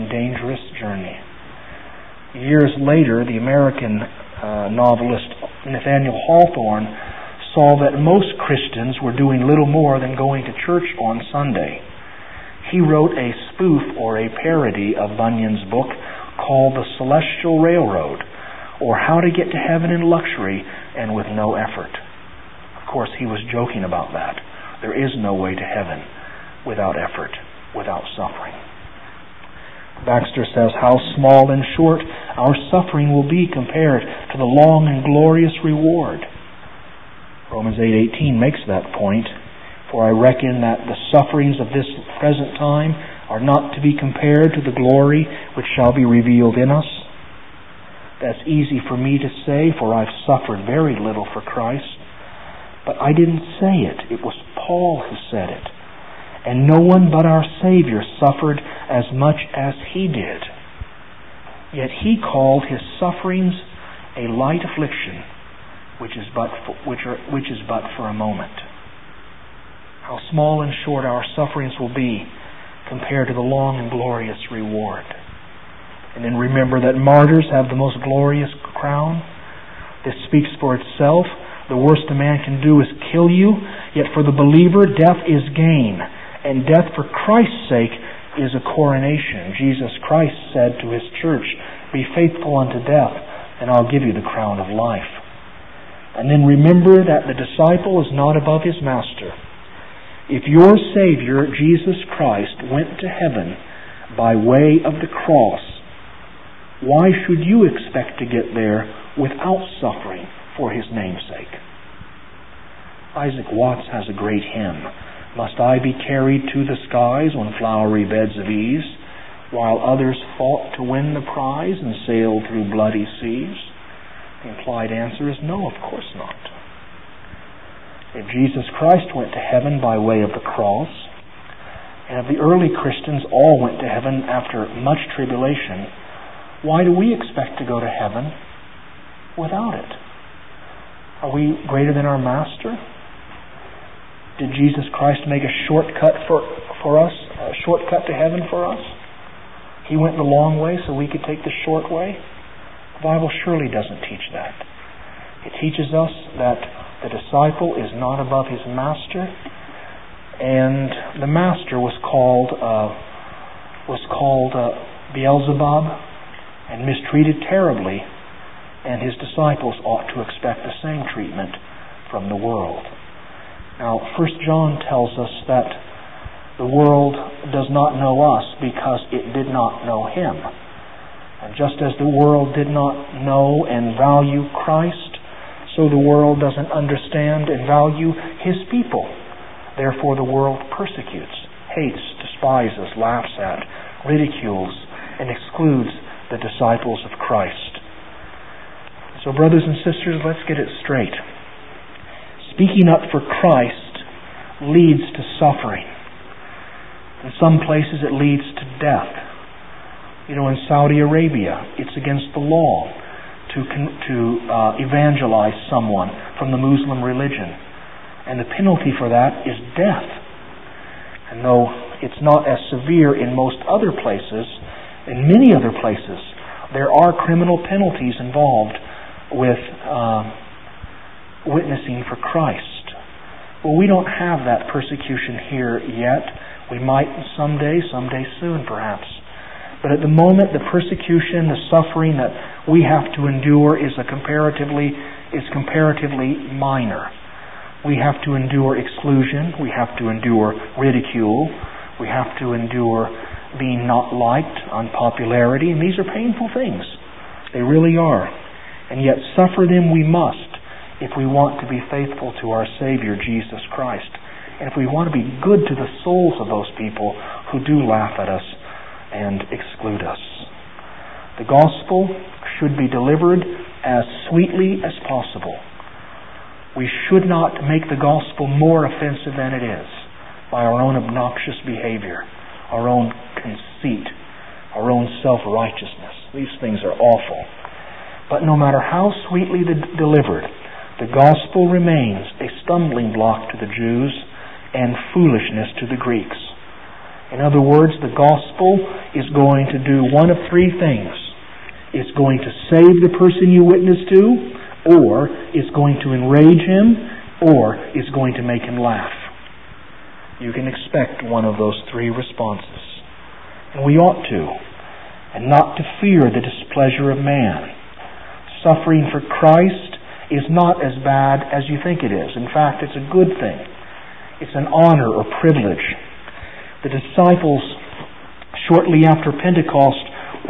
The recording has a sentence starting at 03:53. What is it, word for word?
Well, we don't have that persecution here yet.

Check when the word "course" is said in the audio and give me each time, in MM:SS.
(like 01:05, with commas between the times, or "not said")
00:22, 02:05.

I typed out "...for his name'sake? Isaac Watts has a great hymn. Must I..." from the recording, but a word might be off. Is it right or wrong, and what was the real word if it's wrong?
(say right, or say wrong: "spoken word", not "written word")
right.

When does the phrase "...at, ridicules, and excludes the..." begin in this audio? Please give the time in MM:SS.
03:13.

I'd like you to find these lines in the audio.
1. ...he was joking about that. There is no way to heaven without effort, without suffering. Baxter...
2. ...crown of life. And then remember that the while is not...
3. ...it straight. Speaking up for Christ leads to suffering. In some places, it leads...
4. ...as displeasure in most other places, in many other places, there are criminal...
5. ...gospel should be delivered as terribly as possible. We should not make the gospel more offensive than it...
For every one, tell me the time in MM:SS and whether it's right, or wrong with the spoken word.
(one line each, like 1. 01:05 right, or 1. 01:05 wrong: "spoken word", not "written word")
1. 00:23 right
2. 01:34 wrong: "disciple", not "while"
3. 03:20 right
4. 03:42 wrong: "severe", not "displeasure"
5. 04:31 wrong: "sweetly", not "terribly".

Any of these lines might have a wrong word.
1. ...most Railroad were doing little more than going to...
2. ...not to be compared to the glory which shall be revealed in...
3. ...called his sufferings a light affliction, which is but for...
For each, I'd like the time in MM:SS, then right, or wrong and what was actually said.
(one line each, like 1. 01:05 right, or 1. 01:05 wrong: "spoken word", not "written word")
1. 00:07 wrong: "Christians", not "Railroad"
2. 00:43 right
3. 01:02 right.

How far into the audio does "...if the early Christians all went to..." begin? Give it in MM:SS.
02:12.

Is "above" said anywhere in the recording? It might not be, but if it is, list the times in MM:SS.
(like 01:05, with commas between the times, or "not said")
01:38, 02:38.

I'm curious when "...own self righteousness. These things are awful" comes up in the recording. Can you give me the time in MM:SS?
04:44.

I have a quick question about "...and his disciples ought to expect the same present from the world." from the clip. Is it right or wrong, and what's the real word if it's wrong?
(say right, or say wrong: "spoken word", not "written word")
wrong: "treatment", not "present".